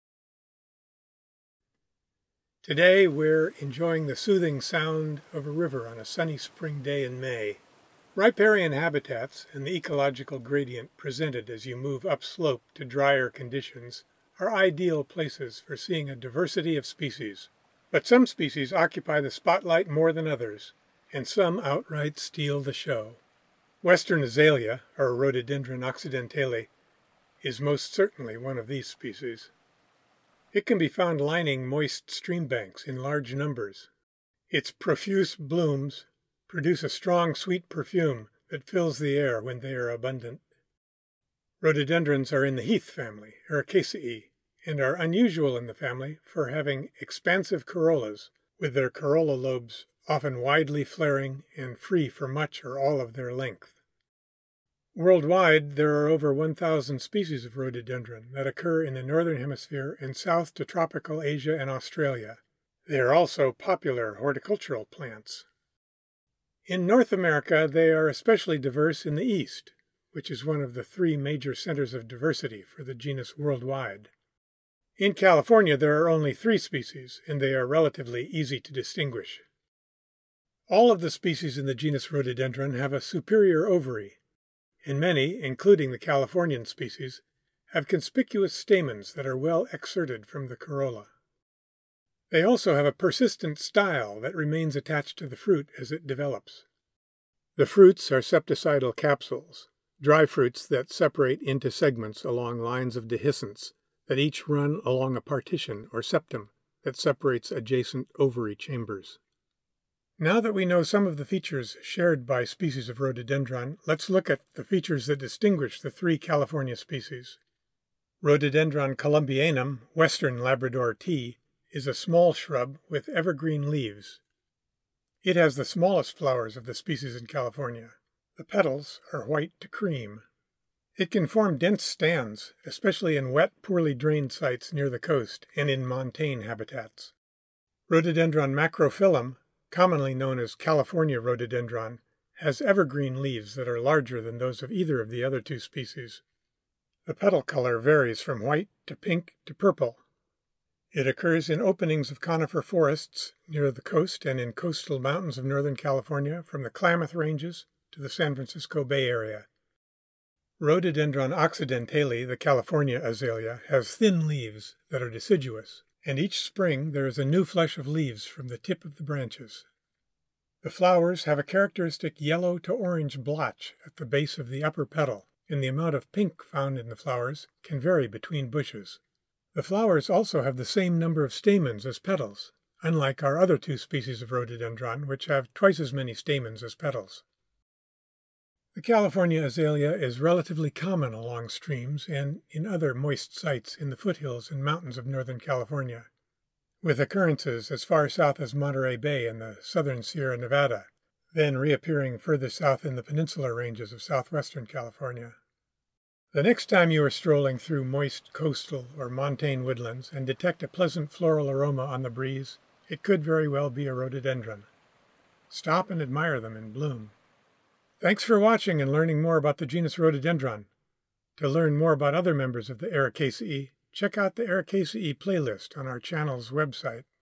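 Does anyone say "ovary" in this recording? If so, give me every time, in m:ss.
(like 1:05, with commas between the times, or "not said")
1:23, 1:48.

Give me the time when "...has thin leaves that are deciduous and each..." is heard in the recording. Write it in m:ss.
2:43.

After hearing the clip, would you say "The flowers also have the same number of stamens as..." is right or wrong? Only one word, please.
right.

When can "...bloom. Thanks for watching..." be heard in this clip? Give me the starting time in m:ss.
3:36.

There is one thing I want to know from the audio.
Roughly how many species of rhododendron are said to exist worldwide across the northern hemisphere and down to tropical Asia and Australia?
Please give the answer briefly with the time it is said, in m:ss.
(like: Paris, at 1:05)
over 1,000, at 0:56.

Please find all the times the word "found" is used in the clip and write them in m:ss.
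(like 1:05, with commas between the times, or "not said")
0:30, 2:56.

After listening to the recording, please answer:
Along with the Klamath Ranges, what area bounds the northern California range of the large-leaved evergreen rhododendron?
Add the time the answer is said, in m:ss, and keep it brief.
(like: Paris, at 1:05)
San Francisco Bay Area, at 2:38.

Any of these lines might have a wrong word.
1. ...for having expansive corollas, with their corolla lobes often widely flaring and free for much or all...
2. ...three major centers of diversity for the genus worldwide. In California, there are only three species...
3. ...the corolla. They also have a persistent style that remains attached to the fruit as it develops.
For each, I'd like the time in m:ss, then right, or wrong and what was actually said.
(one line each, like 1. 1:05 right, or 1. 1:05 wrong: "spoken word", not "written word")
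1. 0:46 right
2. 1:10 right
3. 1:30 right.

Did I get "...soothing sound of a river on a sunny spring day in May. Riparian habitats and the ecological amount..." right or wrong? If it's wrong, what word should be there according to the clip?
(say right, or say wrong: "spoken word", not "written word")
wrong: "gradient", not "amount".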